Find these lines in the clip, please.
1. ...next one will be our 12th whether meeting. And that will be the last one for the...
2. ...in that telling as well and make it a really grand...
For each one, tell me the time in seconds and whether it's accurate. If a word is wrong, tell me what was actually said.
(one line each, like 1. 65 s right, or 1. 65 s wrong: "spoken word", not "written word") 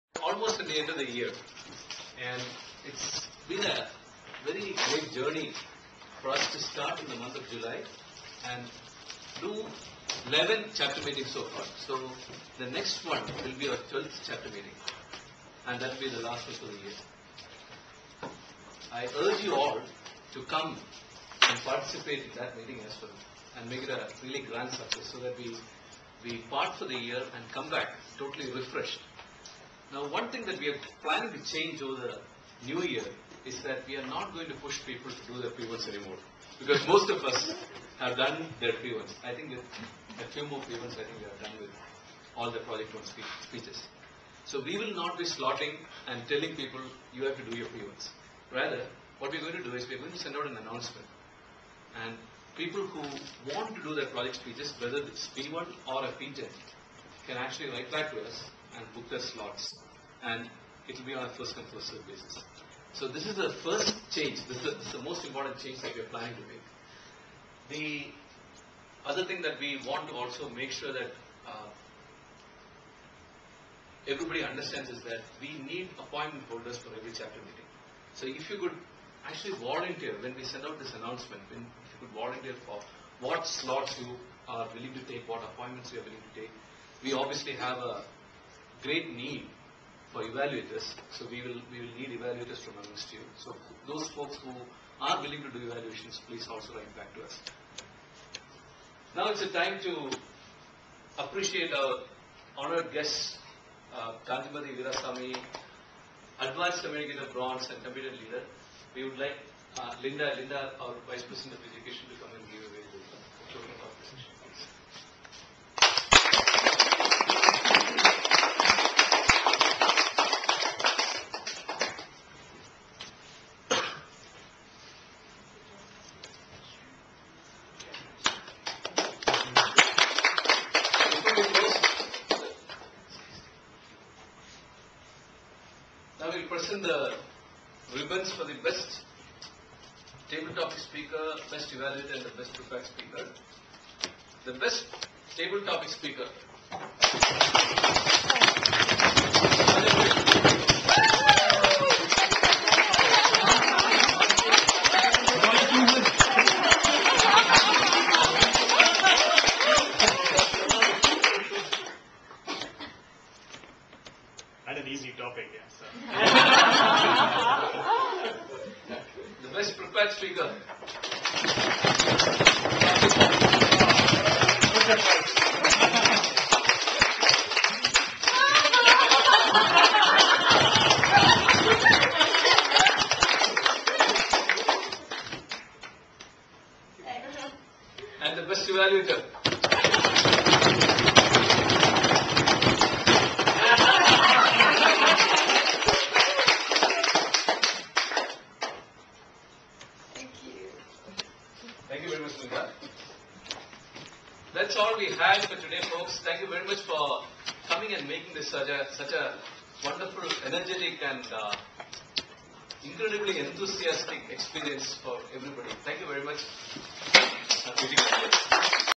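1. 12 s wrong: "chapter", not "whether"
2. 22 s wrong: "meeting", not "telling".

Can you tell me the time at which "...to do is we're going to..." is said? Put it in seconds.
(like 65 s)
49 s.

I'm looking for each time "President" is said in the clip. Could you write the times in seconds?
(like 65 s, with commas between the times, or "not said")
111 s.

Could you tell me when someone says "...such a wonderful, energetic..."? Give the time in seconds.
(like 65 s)
208 s.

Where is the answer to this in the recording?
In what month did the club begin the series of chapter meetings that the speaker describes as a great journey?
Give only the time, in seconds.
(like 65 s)
7 s.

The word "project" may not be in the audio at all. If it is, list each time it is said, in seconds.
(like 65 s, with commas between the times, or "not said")
42 s, 54 s.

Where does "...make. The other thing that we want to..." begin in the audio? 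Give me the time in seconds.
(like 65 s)
66 s.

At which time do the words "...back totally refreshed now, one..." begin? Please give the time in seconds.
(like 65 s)
27 s.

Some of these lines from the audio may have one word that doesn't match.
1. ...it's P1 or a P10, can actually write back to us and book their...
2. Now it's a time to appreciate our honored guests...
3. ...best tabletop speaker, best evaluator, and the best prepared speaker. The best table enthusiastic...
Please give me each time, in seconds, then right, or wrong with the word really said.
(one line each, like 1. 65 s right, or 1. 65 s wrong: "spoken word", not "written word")
1. 54 s right
2. 99 s right
3. 138 s wrong: "topic", not "enthusiastic".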